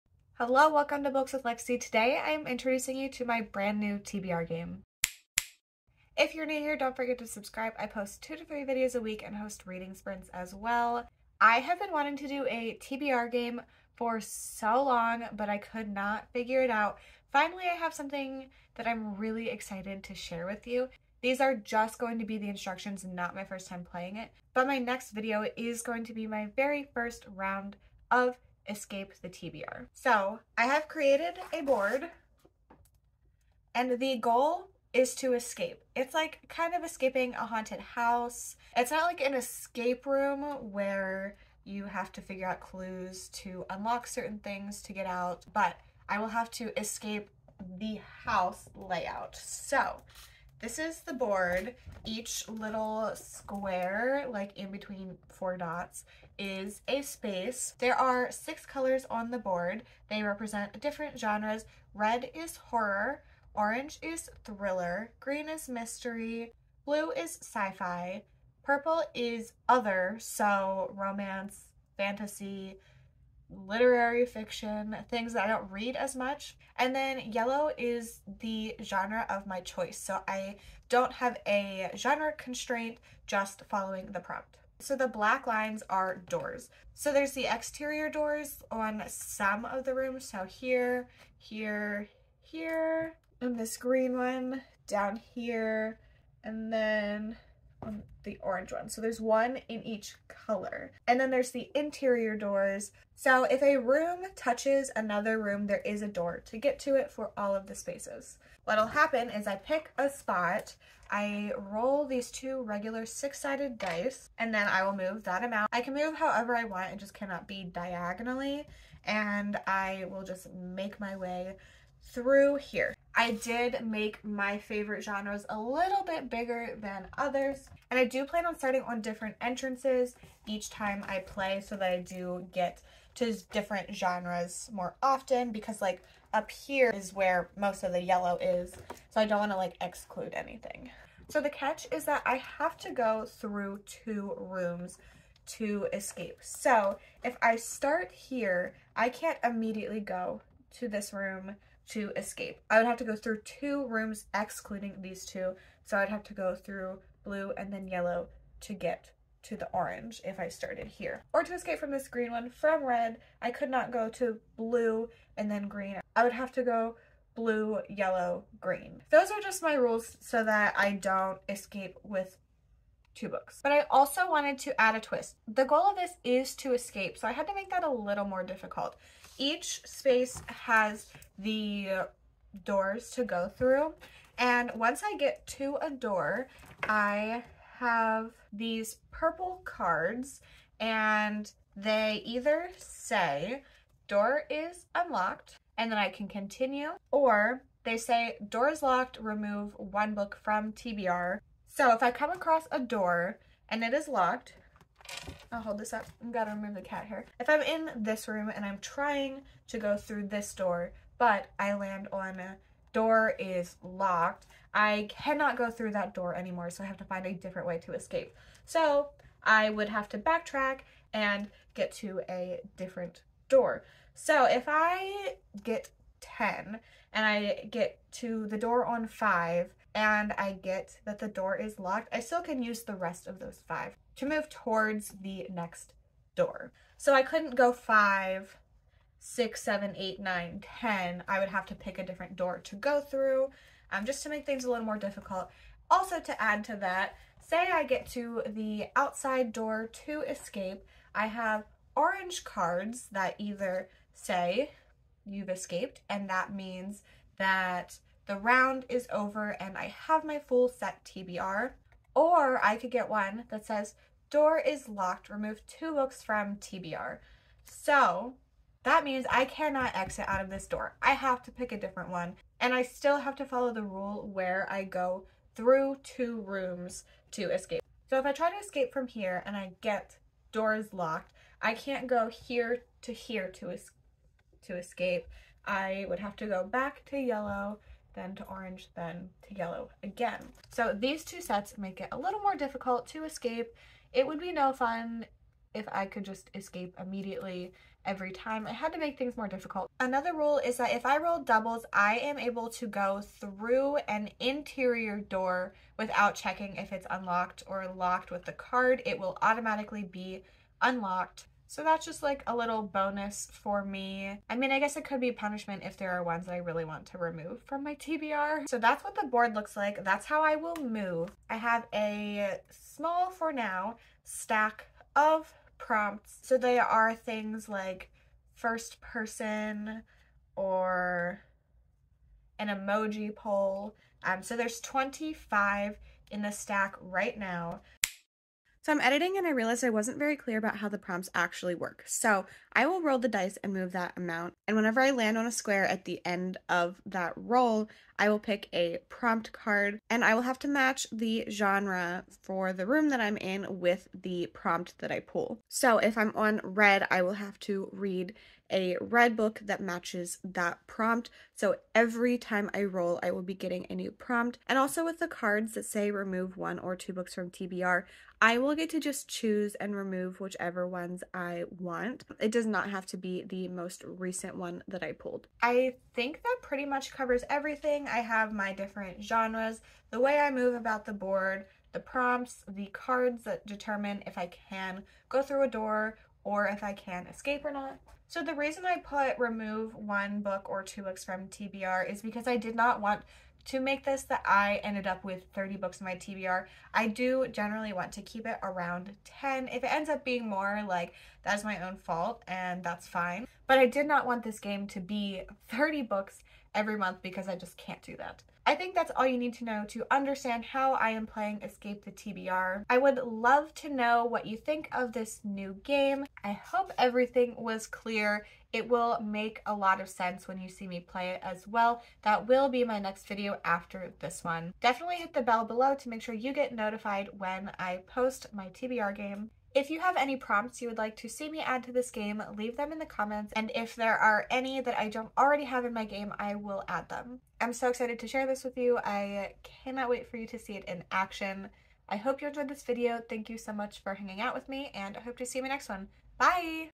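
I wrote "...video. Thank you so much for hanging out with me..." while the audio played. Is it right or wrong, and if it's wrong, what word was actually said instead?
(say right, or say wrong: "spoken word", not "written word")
right.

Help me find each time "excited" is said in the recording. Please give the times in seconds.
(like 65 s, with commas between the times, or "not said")
19 s, 437 s.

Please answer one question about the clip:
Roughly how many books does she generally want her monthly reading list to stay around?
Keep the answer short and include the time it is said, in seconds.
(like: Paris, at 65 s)
10, at 398 s.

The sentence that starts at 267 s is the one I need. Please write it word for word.
So that means I cannot exit out of this door.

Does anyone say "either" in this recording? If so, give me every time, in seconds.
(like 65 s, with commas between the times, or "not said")
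192 s, 253 s.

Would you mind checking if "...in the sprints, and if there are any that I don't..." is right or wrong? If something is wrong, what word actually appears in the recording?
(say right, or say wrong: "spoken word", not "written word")
wrong: "comments", not "sprints".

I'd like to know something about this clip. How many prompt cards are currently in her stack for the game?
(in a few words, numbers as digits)
25.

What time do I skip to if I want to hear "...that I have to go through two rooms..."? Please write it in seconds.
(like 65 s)
142 s.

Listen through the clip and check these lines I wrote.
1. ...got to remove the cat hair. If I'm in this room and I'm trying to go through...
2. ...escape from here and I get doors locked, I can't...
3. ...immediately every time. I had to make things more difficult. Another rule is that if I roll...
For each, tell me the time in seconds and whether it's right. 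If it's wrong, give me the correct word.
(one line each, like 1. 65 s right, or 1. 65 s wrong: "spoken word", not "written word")
1. 206 s right
2. 278 s right
3. 296 s right.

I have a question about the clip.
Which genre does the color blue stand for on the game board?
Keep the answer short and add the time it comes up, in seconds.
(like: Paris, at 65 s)
sci-fi, at 66 s.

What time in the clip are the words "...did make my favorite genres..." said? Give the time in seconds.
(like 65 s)
123 s.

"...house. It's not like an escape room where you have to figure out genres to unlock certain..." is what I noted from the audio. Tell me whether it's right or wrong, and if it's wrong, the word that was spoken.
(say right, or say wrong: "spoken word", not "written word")
wrong: "clues", not "genres".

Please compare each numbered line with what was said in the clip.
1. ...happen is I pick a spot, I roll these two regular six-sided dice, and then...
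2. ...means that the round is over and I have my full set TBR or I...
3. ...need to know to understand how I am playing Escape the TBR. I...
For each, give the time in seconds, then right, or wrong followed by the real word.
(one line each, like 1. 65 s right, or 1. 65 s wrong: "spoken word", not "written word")
1. 108 s right
2. 256 s right
3. 409 s right.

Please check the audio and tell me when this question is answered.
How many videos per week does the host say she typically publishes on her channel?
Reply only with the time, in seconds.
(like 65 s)
8 s.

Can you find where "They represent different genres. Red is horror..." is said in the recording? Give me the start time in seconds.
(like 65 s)
60 s.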